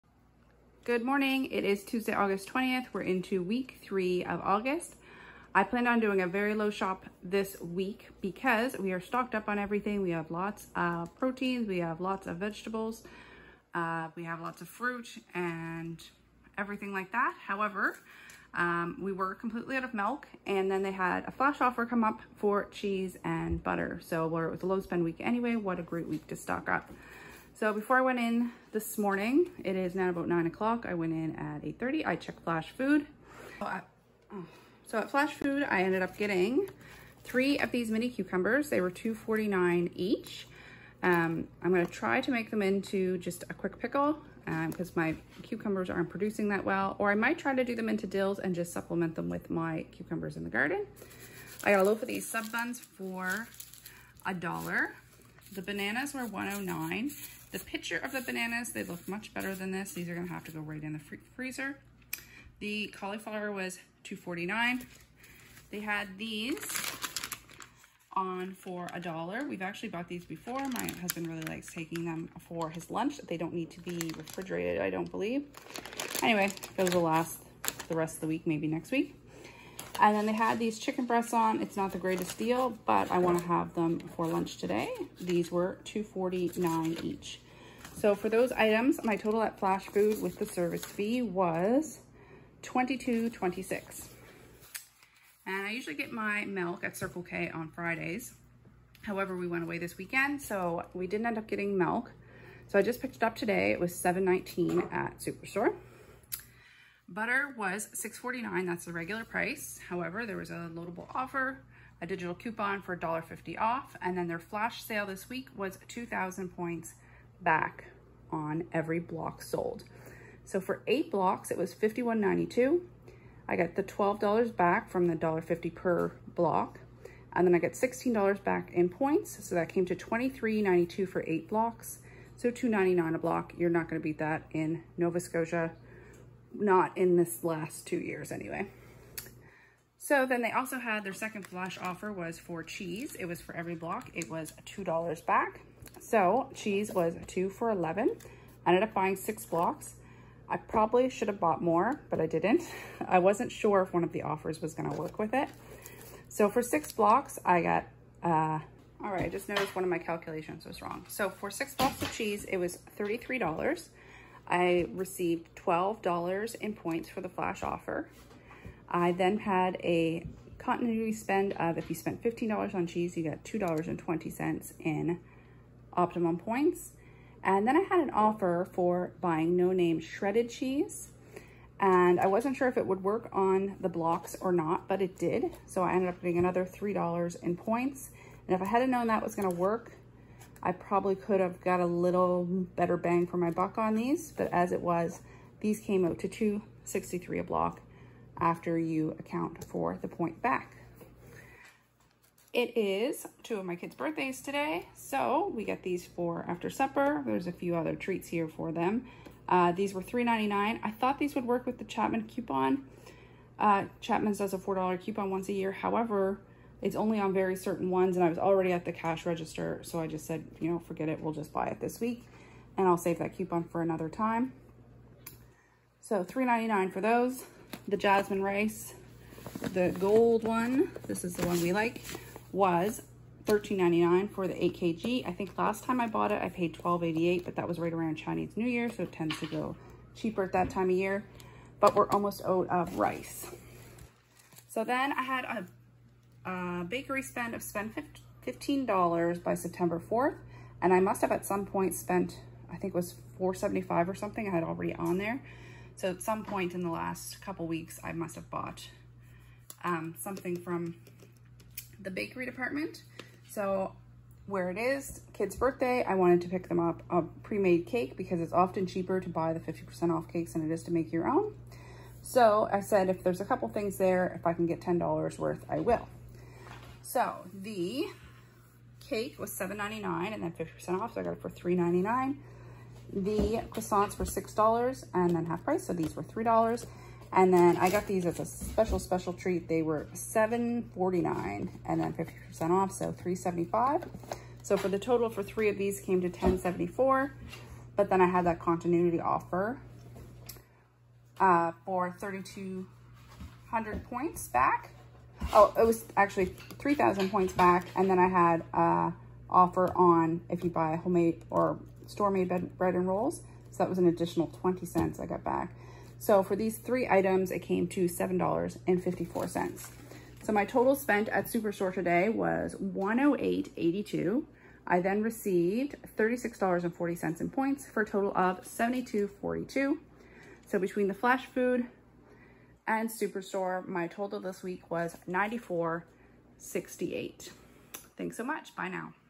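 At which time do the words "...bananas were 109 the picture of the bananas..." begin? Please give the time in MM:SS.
00:55.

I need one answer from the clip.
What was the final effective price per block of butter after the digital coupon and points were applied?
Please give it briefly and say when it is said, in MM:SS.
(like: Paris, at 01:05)
$2.99, at 02:12.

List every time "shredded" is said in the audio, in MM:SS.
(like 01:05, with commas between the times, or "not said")
02:59.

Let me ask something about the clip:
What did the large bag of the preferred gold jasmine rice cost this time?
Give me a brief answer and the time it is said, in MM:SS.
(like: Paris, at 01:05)
$13.99, at 03:53.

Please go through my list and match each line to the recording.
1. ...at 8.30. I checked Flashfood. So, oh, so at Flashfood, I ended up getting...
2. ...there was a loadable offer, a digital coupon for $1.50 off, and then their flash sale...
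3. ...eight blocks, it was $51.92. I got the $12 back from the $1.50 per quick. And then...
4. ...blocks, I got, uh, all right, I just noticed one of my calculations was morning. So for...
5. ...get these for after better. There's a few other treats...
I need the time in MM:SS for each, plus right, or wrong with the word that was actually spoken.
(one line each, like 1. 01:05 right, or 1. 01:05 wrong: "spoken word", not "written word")
1. 00:31 right
2. 01:50 right
3. 02:00 wrong: "block", not "quick"
4. 02:36 wrong: "wrong", not "morning"
5. 03:25 wrong: "supper", not "better".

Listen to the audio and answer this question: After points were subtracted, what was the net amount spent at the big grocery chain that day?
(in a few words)
$72.42.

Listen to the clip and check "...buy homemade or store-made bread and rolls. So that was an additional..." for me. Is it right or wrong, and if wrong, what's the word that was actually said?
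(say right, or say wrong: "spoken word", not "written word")
right.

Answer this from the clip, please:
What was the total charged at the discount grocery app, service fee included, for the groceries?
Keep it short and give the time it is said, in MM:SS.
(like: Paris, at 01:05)
$22.26, at 01:32.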